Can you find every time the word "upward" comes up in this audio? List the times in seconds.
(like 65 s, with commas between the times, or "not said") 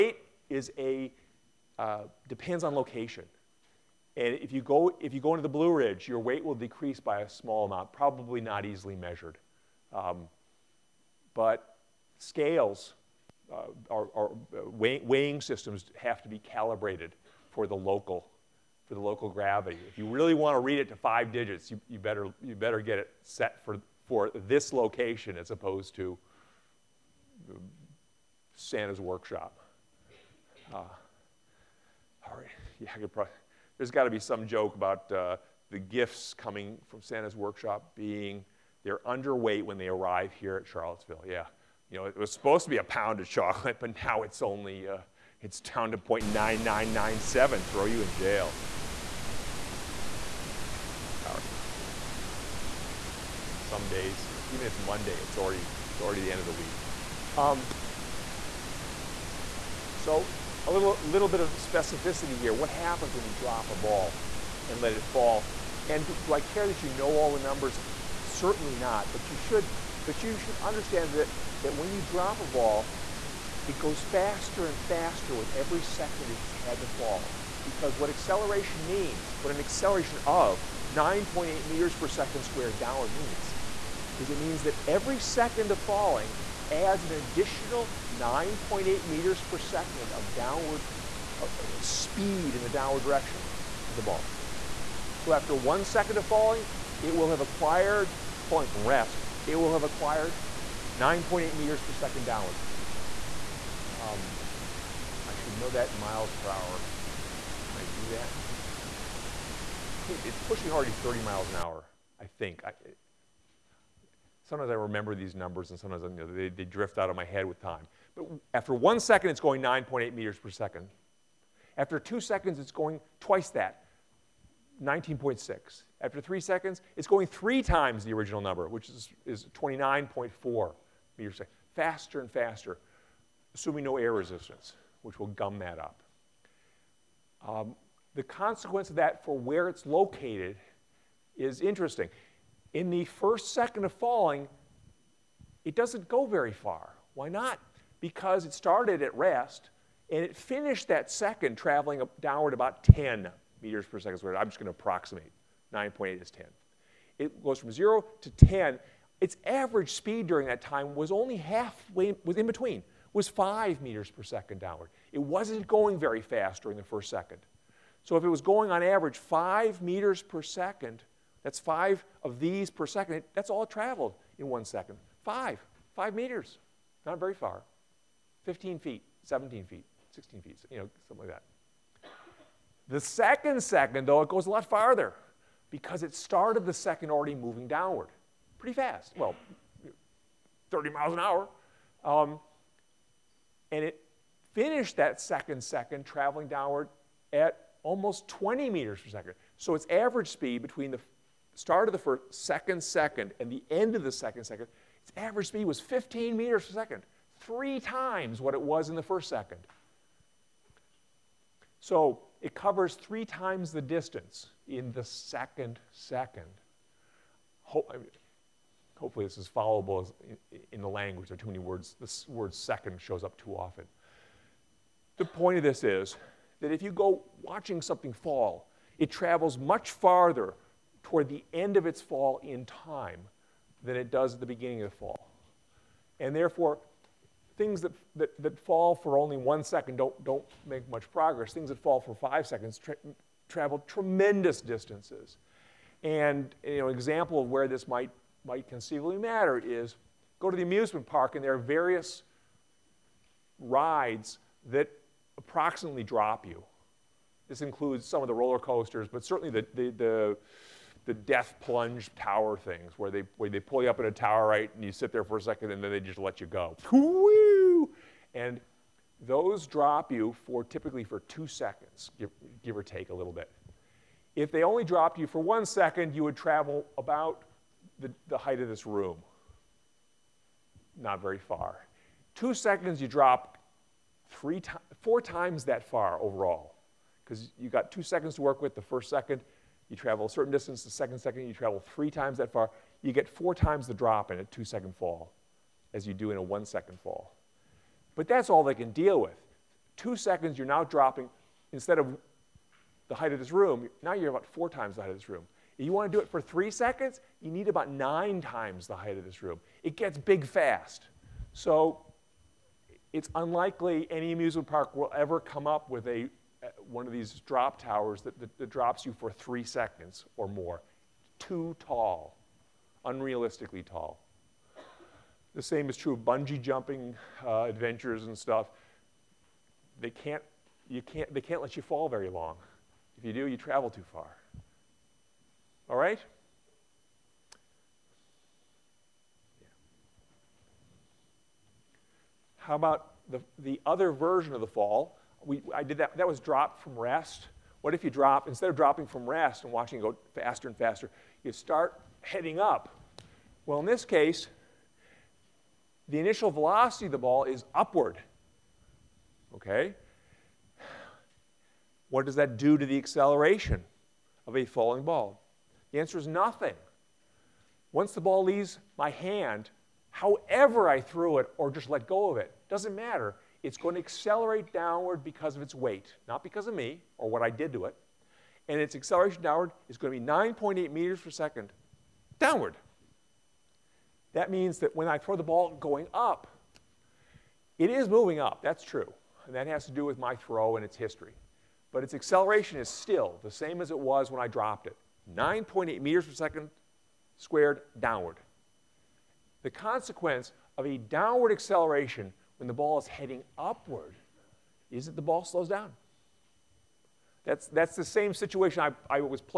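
357 s, 403 s.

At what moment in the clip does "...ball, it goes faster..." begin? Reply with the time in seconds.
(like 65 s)
72 s.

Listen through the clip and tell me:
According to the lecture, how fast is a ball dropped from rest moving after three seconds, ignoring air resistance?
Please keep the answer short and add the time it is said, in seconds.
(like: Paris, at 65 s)
29.4 meters per second, at 129 s.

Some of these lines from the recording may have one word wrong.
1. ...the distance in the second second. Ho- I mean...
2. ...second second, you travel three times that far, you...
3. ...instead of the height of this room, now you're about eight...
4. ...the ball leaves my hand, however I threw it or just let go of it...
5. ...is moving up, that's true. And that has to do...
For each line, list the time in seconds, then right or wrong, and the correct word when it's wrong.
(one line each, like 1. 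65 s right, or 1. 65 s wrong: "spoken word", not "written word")
1. 213 s right
2. 290 s right
3. 301 s wrong: "four", not "eight"
4. 368 s right
5. 387 s right.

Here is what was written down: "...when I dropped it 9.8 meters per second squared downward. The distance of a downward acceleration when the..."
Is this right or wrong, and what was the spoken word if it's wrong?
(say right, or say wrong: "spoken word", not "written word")
wrong: "consequence", not "distance".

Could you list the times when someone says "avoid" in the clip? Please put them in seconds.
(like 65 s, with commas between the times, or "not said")
not said.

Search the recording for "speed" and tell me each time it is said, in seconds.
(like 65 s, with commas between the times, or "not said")
91 s, 159 s, 200 s, 205 s.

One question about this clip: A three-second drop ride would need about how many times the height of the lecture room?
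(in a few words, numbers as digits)
9 times.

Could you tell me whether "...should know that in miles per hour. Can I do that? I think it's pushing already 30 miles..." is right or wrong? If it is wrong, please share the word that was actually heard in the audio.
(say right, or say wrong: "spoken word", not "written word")
right.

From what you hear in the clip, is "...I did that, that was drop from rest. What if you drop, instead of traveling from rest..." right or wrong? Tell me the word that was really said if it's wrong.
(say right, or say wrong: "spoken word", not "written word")
wrong: "dropping", not "traveling".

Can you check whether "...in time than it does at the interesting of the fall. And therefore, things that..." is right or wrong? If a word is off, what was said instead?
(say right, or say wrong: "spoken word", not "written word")
wrong: "beginning", not "interesting".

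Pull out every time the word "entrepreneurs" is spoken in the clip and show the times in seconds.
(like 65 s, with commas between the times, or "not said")
not said.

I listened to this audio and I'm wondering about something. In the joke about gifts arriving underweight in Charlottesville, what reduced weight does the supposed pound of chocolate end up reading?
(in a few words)
0.9997.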